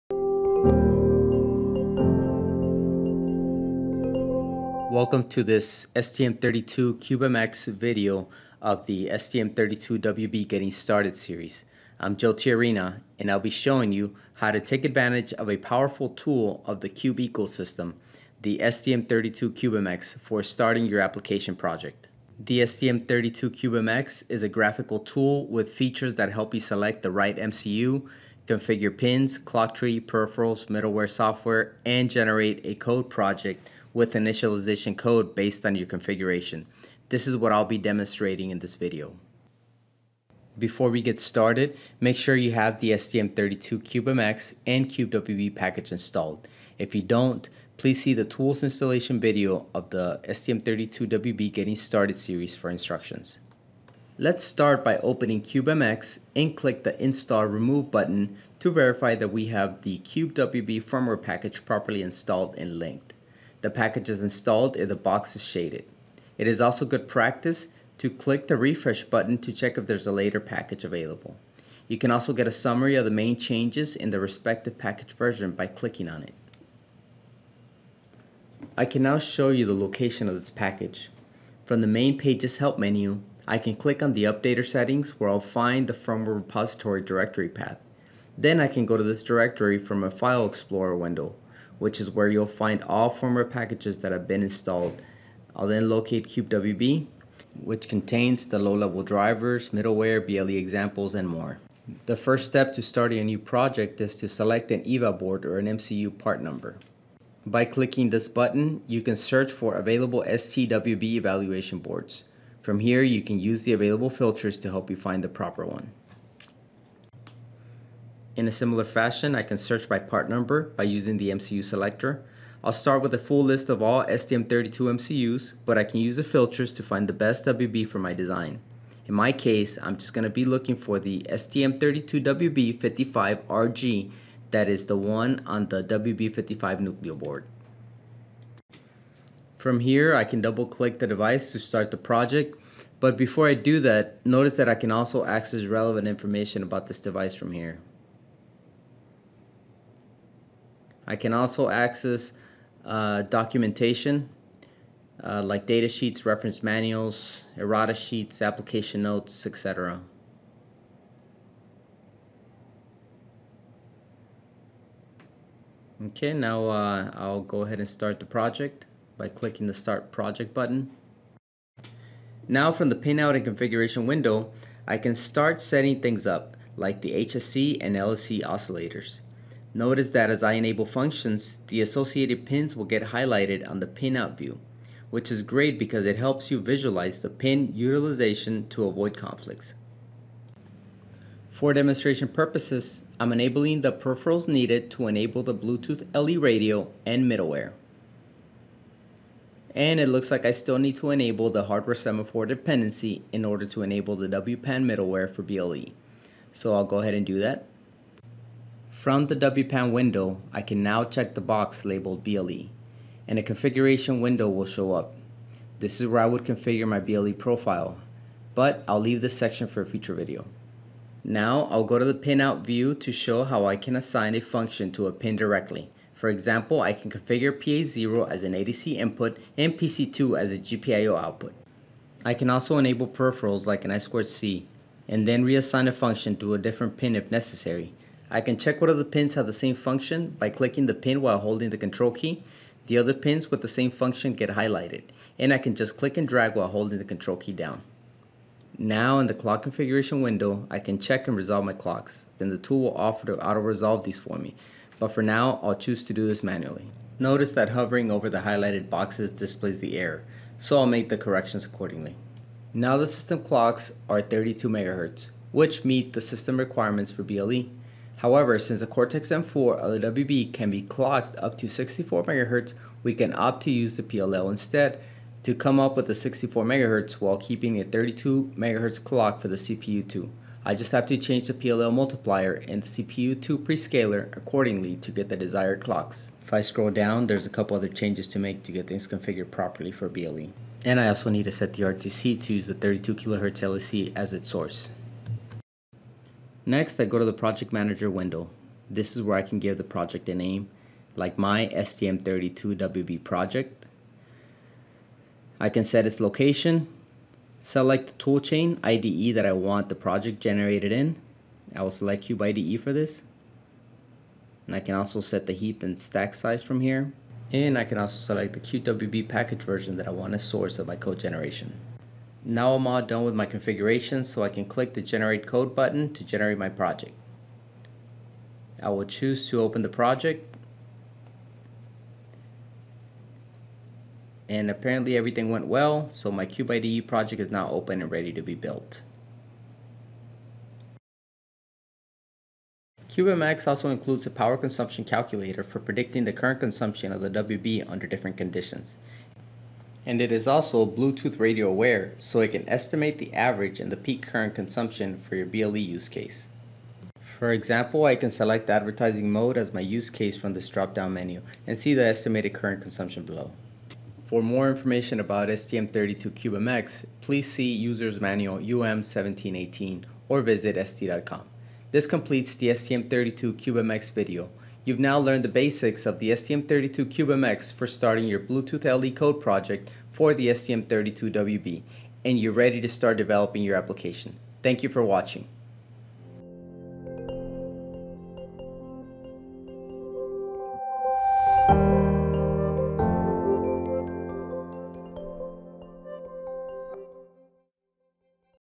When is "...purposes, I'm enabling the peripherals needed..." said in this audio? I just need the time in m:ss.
3:12.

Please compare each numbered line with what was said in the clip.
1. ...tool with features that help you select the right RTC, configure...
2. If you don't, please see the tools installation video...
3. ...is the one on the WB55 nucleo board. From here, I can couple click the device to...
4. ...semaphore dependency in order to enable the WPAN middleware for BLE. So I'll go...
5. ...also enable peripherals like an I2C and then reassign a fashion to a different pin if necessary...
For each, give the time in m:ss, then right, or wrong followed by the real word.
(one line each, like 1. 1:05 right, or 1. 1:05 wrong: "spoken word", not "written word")
1. 0:24 wrong: "MCU", not "RTC"
2. 0:46 right
3. 2:14 wrong: "double", not "couple"
4. 3:21 right
5. 3:52 wrong: "function", not "fashion".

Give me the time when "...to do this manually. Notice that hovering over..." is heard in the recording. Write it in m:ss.
4:16.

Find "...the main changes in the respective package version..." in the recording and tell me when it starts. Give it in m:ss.
1:13.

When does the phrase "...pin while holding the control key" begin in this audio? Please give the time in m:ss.
4:00.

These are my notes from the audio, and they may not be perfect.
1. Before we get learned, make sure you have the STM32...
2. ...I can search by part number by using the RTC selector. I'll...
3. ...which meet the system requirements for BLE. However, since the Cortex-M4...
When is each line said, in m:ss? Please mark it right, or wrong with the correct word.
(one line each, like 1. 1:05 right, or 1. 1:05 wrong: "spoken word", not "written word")
1. 0:40 wrong: "started", not "learned"
2. 1:59 wrong: "MCU", not "RTC"
3. 4:25 right.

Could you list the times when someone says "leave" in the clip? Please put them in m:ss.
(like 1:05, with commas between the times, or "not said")
3:38.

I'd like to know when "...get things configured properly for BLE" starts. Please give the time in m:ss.
4:48.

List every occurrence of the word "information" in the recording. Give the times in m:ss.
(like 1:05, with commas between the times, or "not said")
2:26, 6:04.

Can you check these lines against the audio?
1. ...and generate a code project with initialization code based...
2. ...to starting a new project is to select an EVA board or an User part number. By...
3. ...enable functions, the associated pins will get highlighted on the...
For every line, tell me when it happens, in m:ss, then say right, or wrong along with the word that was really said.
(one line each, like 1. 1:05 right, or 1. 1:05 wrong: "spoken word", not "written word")
1. 0:31 right
2. 1:42 wrong: "MCU", not "User"
3. 3:00 right.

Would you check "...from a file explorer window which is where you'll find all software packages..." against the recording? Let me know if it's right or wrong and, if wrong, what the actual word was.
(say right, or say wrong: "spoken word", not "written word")
wrong: "firmware", not "software".